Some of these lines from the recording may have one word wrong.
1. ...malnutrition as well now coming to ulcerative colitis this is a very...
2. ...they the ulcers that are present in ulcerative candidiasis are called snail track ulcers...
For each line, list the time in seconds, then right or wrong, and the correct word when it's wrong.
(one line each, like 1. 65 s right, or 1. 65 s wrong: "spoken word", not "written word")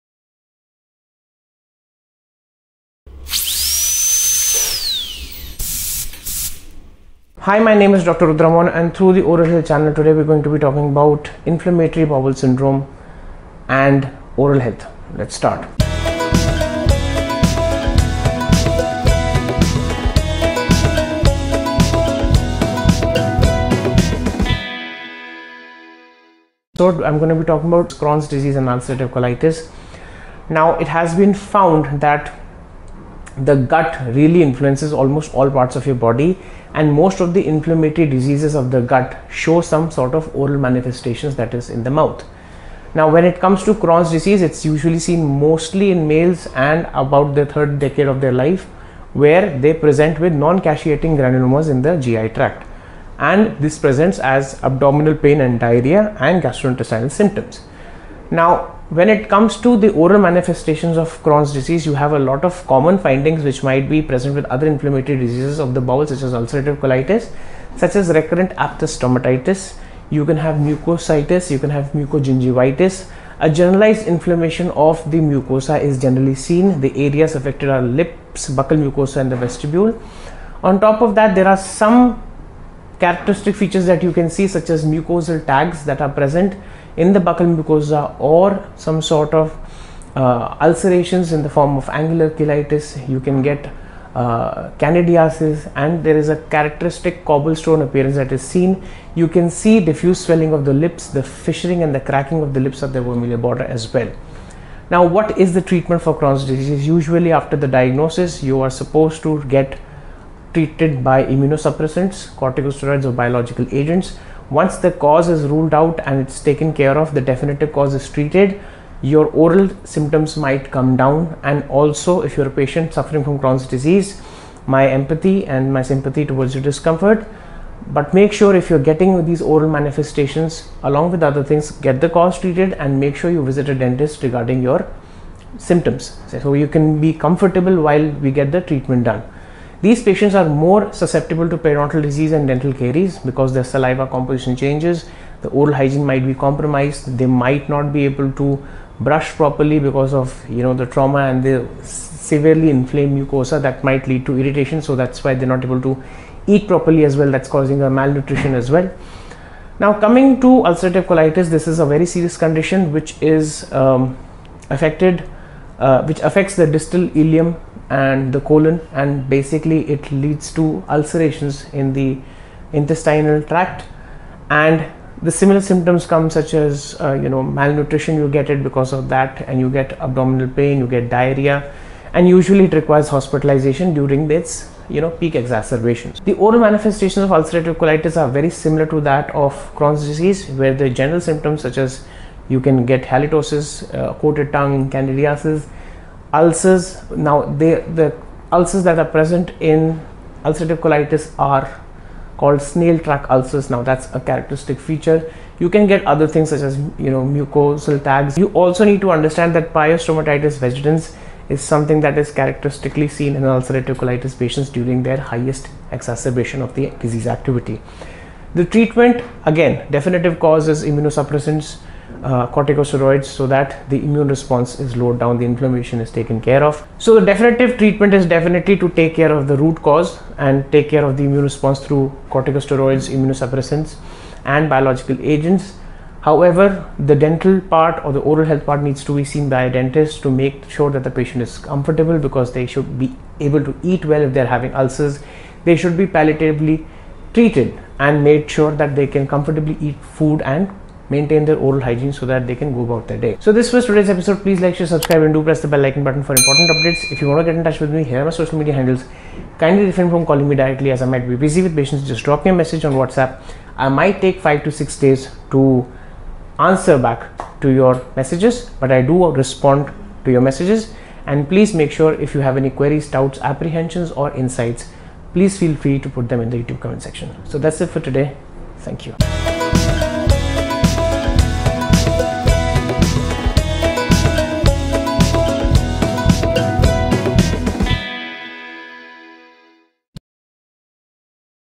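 1. 157 s right
2. 197 s wrong: "colitis", not "candidiasis".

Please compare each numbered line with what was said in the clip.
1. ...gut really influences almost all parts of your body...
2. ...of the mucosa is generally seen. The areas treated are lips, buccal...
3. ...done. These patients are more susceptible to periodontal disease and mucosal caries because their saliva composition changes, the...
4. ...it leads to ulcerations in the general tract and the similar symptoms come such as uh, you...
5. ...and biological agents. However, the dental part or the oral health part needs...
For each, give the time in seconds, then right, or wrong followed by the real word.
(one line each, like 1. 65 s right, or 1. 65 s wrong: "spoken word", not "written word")
1. 33 s right
2. 74 s wrong: "affected", not "treated"
3. 139 s wrong: "dental", not "mucosal"
4. 169 s wrong: "intestinal", not "general"
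5. 234 s right.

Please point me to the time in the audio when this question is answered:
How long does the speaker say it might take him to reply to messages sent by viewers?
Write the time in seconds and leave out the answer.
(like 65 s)
264 s.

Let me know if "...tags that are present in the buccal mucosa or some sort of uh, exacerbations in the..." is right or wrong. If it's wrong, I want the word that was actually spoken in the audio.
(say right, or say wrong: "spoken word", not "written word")
wrong: "ulcerations", not "exacerbations".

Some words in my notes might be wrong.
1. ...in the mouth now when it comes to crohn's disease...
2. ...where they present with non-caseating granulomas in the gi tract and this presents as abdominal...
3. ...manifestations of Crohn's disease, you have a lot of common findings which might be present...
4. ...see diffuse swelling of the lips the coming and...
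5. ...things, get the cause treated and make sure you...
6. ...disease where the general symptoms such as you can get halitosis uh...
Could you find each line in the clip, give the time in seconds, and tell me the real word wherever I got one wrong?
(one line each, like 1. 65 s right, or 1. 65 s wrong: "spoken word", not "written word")
1. 41 s right
2. 49 s right
3. 60 s right
4. 99 s wrong: "fissuring", not "coming"
5. 131 s right
6. 190 s right.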